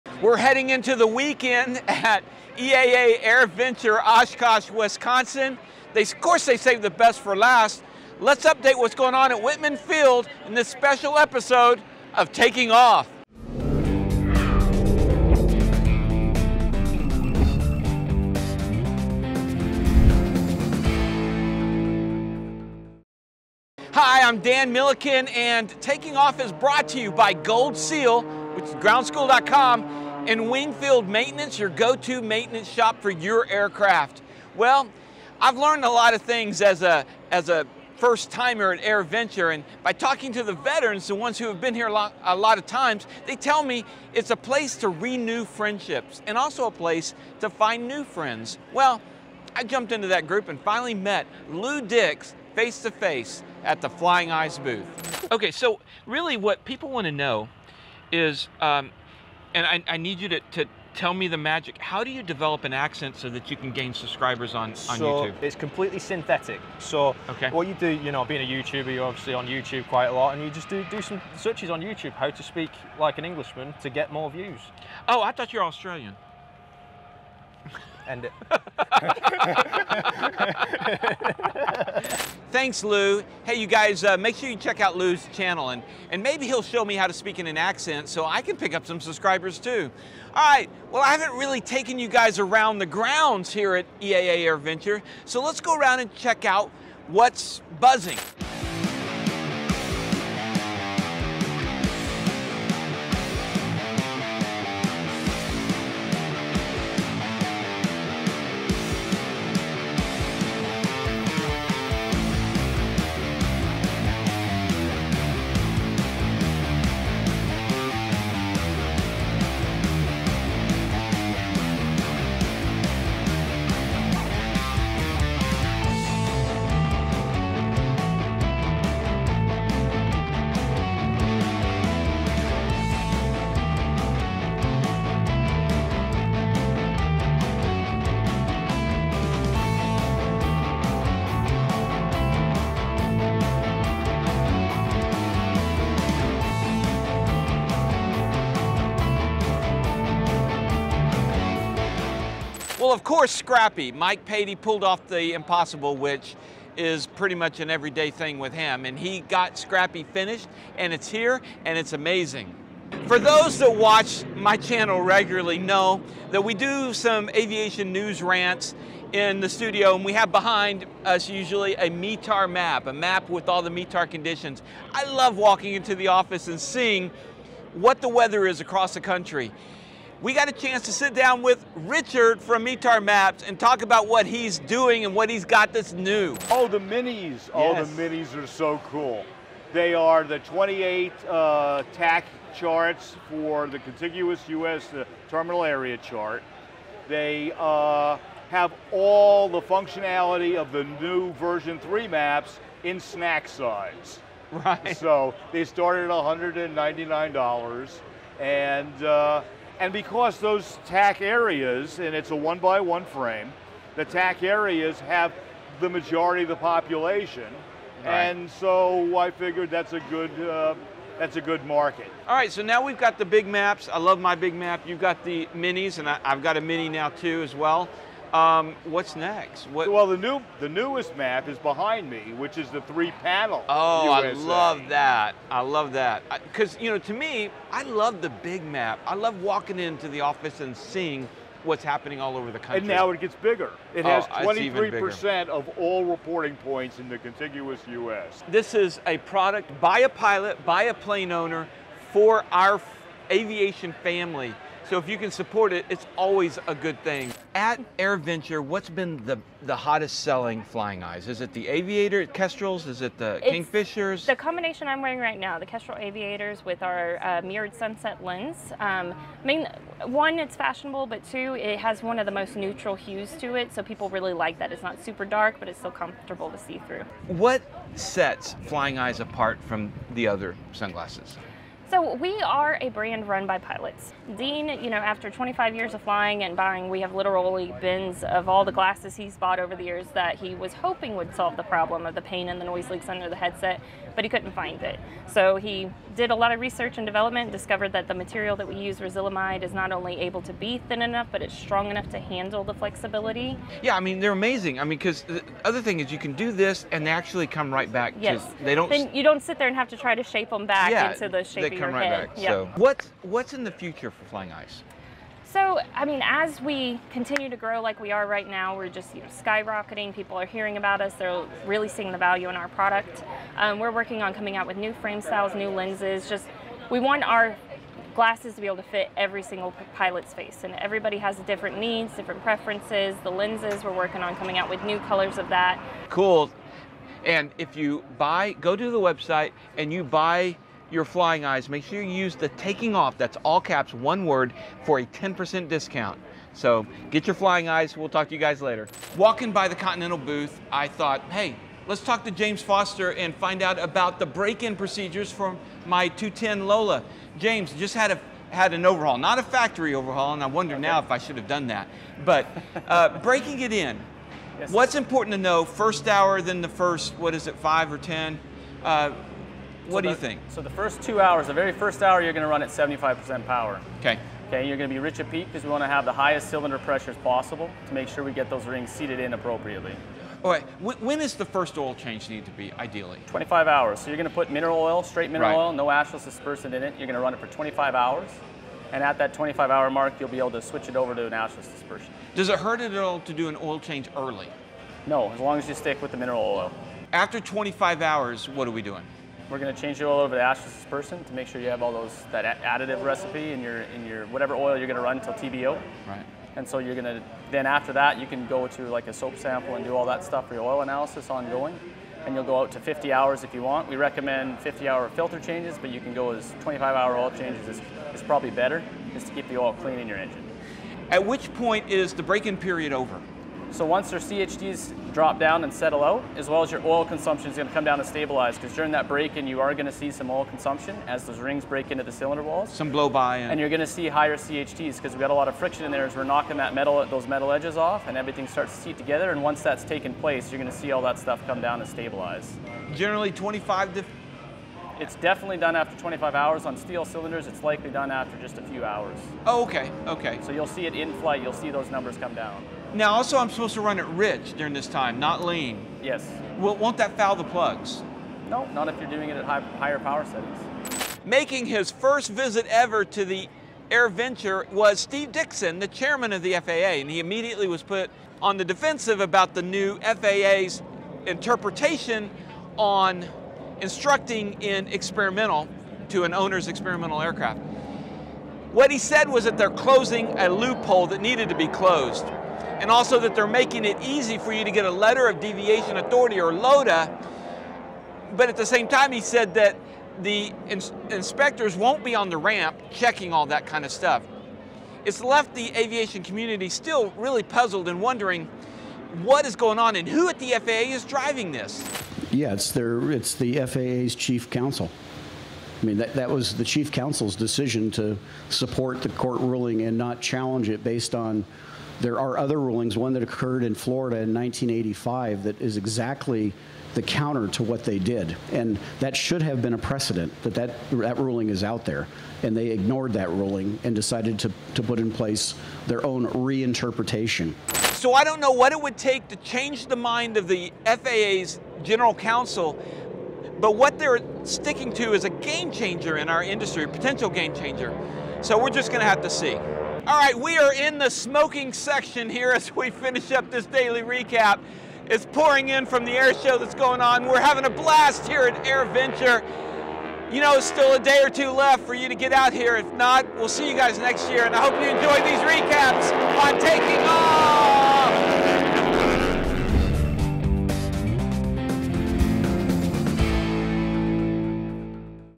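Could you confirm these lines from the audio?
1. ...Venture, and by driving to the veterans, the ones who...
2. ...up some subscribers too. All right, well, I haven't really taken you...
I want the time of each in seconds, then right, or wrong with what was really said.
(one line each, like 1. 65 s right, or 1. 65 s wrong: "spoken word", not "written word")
1. 39 s wrong: "talking", not "driving"
2. 88 s right.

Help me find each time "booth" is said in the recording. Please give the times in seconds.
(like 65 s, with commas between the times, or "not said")
54 s, 350 s.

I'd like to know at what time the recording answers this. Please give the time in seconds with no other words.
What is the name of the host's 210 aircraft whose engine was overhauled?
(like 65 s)
356 s.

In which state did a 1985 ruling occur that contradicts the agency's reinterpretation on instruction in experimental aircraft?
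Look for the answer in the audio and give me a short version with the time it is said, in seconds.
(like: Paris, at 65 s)
Florida, at 513 s.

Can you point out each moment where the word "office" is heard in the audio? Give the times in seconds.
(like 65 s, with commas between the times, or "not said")
176 s, 240 s.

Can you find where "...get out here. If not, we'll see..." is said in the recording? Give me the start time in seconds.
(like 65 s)
552 s.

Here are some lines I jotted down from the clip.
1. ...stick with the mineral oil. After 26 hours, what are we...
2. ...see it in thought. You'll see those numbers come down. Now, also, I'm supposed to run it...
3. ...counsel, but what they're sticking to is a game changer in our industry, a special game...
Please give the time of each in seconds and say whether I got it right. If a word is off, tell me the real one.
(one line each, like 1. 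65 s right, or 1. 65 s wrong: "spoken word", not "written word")
1. 395 s wrong: "25", not "26"
2. 450 s wrong: "flight", not "thought"
3. 532 s wrong: "potential", not "special".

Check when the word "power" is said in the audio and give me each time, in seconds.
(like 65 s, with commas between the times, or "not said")
373 s, 459 s.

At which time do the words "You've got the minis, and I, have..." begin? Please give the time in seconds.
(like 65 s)
224 s.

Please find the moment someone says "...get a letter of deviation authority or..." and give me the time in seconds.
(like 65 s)
484 s.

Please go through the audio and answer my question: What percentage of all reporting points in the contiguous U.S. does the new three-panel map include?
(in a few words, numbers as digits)
23%.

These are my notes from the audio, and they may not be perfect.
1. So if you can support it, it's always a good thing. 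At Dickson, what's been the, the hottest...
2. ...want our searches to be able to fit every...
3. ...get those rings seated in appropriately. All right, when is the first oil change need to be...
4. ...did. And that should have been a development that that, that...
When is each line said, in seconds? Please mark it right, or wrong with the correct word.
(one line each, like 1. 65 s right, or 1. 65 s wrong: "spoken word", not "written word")
1. 254 s wrong: "AirVenture", not "Dickson"
2. 327 s wrong: "glasses", not "searches"
3. 378 s right
4. 517 s wrong: "precedent", not "development".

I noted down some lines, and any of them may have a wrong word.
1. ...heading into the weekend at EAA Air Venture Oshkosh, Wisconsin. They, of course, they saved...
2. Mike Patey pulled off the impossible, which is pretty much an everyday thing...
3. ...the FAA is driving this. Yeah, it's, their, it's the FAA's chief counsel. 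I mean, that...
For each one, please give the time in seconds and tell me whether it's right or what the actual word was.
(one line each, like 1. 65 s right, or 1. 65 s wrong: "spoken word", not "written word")
1. 0 s right
2. 153 s right
3. 500 s right.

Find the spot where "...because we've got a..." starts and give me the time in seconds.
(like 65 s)
434 s.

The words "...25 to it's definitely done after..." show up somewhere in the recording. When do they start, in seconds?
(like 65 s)
443 s.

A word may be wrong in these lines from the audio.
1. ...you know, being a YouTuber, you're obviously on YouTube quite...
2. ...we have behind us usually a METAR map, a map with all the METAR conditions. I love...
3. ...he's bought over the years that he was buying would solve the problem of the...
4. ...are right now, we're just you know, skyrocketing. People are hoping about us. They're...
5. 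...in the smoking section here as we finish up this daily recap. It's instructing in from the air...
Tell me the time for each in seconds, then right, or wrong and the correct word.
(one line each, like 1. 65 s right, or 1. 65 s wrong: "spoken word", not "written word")
1. 67 s right
2. 170 s right
3. 289 s wrong: "hoping", not "buying"
4. 318 s wrong: "hearing", not "hoping"
5. 540 s wrong: "pouring", not "instructing".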